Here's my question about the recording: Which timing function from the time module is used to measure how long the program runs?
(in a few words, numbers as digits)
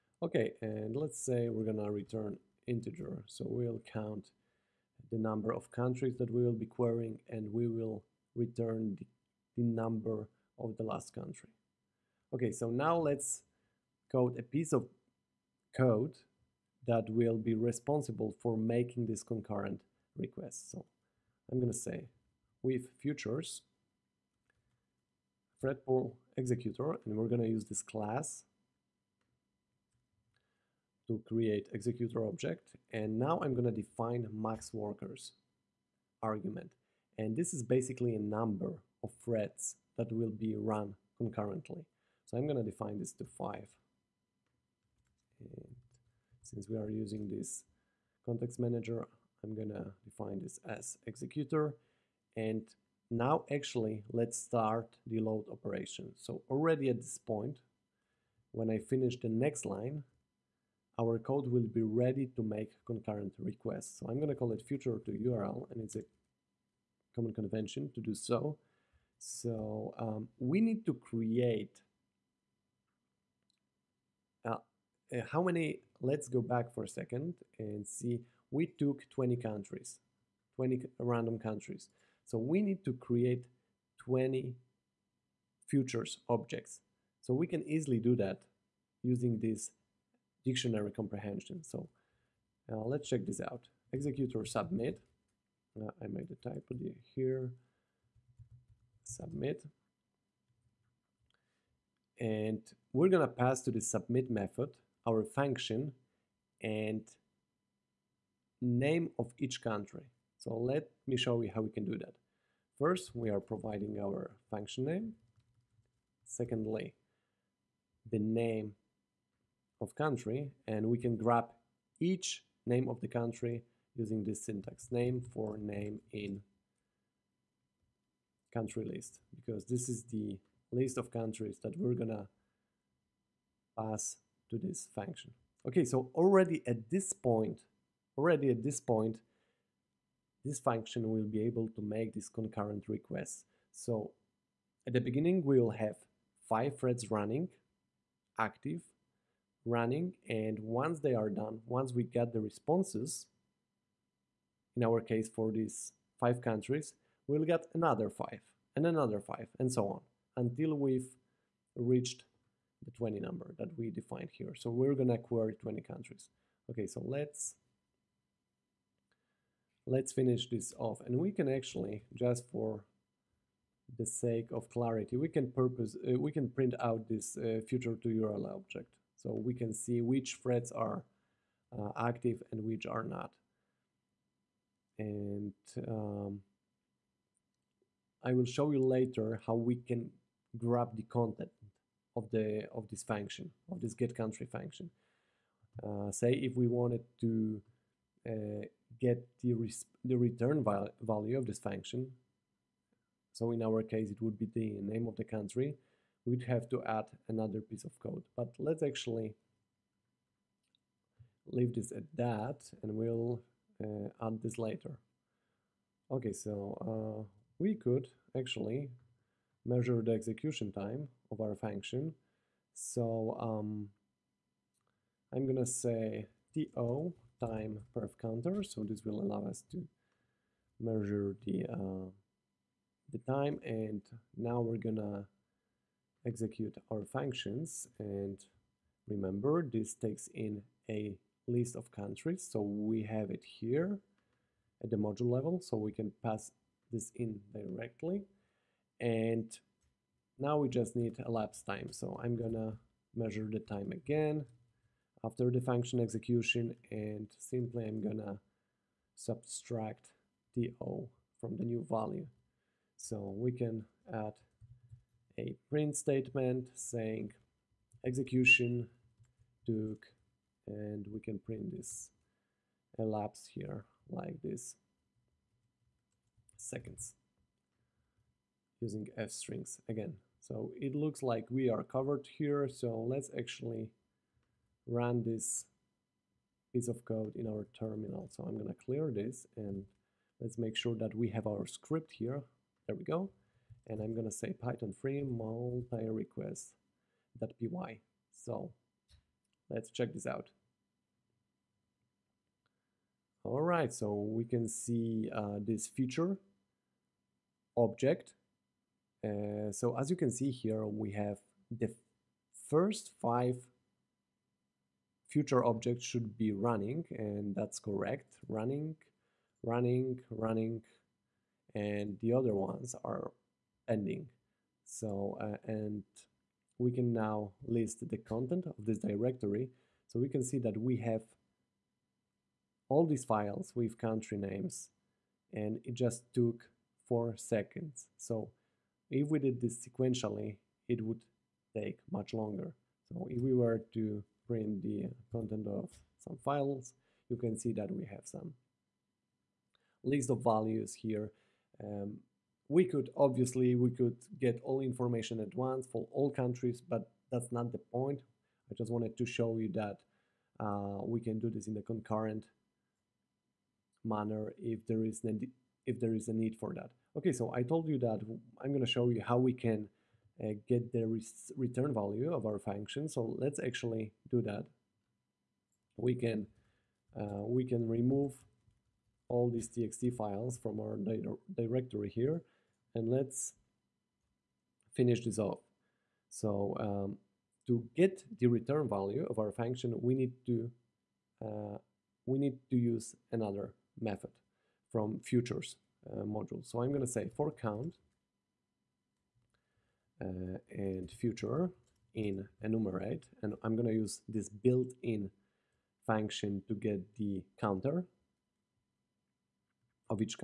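perf counter.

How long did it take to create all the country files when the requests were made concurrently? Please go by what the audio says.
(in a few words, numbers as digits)
4 seconds.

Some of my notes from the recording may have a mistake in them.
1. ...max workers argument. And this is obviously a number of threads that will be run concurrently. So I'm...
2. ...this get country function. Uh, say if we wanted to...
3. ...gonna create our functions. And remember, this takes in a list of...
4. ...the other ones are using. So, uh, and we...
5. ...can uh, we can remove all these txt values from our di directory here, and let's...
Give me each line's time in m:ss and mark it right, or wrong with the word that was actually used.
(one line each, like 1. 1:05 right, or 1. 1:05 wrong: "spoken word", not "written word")
1. 0:34 wrong: "basically", not "obviously"
2. 3:13 right
3. 3:54 wrong: "execute", not "create"
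4. 5:22 wrong: "ending", not "using"
5. 6:16 wrong: "files", not "values".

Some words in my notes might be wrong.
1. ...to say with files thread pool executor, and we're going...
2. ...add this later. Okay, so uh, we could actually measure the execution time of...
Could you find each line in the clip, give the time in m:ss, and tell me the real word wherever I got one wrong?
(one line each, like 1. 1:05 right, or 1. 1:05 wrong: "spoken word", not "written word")
1. 0:21 wrong: "futures", not "files"
2. 3:34 right.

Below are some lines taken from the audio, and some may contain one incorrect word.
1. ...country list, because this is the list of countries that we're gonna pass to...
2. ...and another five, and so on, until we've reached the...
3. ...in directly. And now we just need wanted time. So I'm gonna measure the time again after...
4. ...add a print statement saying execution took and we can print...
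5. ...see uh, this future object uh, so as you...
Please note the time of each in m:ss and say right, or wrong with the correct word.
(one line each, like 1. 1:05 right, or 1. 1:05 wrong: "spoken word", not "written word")
1. 2:08 right
2. 2:38 right
3. 4:07 wrong: "elapsed", not "wanted"
4. 4:24 right
5. 5:04 right.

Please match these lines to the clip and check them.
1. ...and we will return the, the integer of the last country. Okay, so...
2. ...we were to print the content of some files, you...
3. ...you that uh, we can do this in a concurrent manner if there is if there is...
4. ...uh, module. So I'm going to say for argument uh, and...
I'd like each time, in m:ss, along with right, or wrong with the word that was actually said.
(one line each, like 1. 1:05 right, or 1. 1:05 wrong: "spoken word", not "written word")
1. 0:07 wrong: "number", not "integer"
2. 5:43 right
3. 5:59 right
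4. 6:36 wrong: "count", not "argument".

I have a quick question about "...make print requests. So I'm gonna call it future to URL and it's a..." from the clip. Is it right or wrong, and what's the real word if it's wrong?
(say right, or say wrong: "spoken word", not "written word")
wrong: "concurrent", not "print".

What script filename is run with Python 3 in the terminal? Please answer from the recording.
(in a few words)
multi-request.py.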